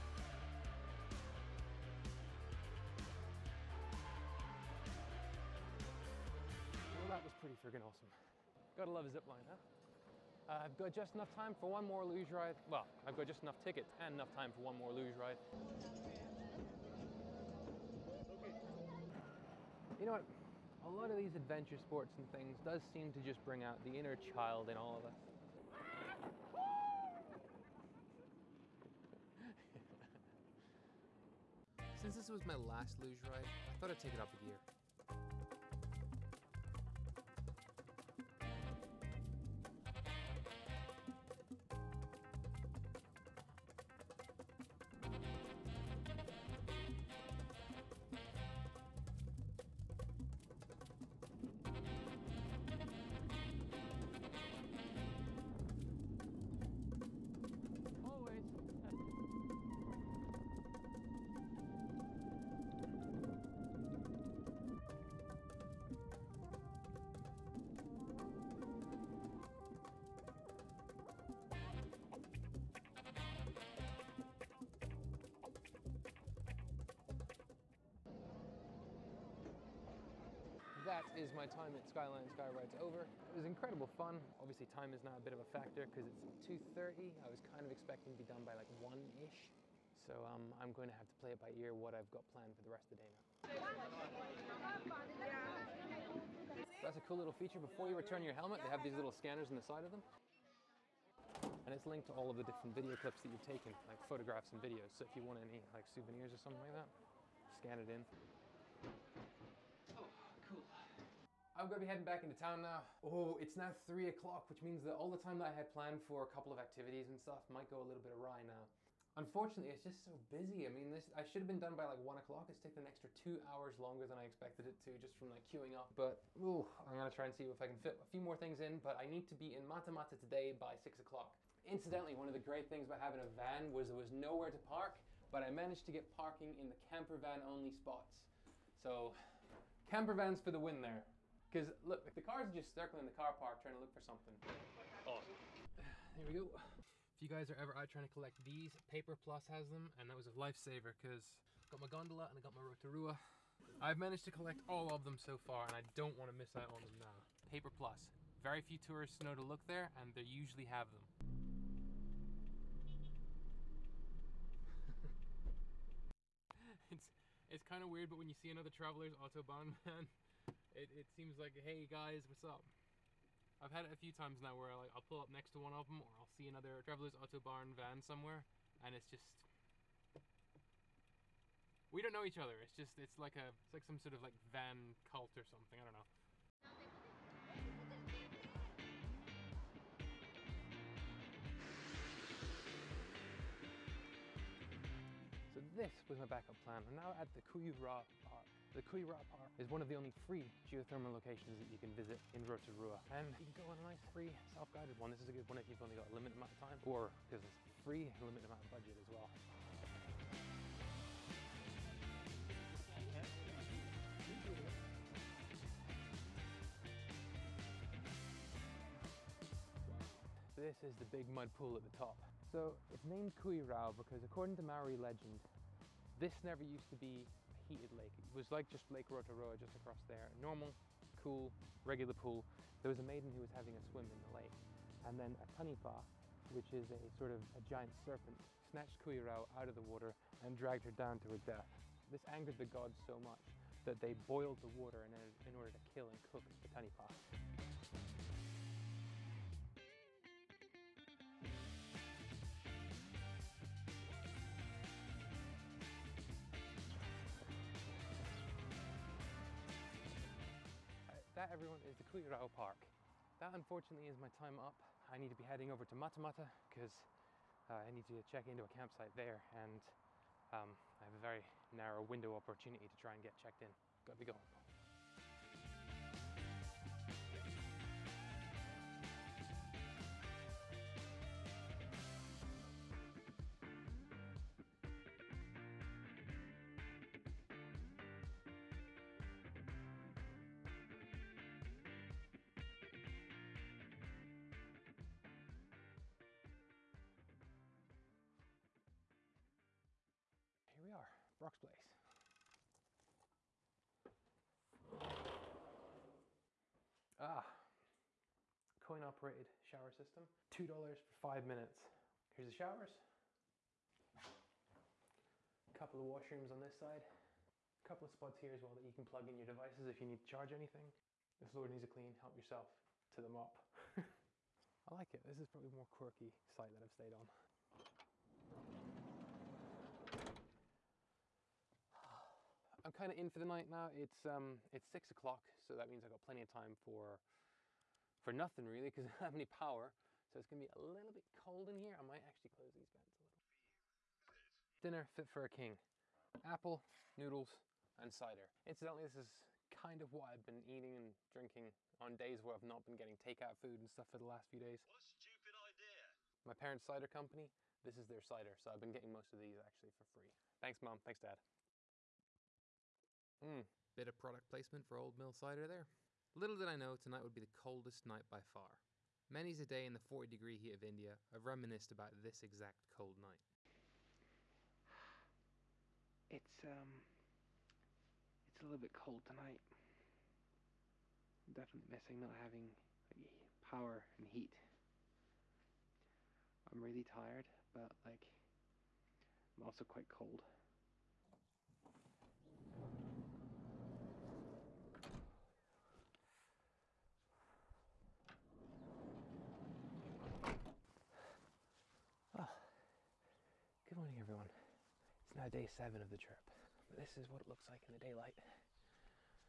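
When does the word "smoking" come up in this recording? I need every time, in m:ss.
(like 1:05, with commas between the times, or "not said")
not said.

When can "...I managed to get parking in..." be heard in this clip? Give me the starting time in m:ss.
2:15.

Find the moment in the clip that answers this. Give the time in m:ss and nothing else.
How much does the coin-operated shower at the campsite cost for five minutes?
5:10.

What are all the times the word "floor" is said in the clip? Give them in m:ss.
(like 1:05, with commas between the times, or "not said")
5:21.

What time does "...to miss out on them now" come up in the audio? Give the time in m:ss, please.
2:36.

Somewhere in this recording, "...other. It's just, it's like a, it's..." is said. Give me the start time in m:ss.
3:02.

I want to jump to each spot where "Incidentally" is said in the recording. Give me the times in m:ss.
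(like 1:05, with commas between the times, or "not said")
2:11, 5:48.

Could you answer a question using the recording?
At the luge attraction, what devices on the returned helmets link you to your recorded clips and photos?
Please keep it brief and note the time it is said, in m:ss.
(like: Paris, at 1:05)
scanners, at 1:39.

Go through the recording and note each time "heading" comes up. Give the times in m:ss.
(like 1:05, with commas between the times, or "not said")
1:51, 4:25.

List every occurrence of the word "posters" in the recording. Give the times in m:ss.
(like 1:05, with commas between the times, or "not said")
not said.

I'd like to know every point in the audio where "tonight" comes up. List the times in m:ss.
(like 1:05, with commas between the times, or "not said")
6:06, 6:19.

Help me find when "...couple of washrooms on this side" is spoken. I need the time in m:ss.
5:15.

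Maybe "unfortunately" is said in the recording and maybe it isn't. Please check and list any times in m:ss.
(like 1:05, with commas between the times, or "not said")
1:59, 4:23.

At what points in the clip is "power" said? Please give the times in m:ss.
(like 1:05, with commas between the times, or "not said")
5:39, 6:23.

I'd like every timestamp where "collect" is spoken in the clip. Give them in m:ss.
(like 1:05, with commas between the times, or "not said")
2:28, 2:34.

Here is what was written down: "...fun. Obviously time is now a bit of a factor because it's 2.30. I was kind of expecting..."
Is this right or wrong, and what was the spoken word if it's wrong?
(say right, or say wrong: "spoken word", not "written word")
right.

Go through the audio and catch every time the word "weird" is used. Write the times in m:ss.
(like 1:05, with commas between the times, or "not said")
2:47.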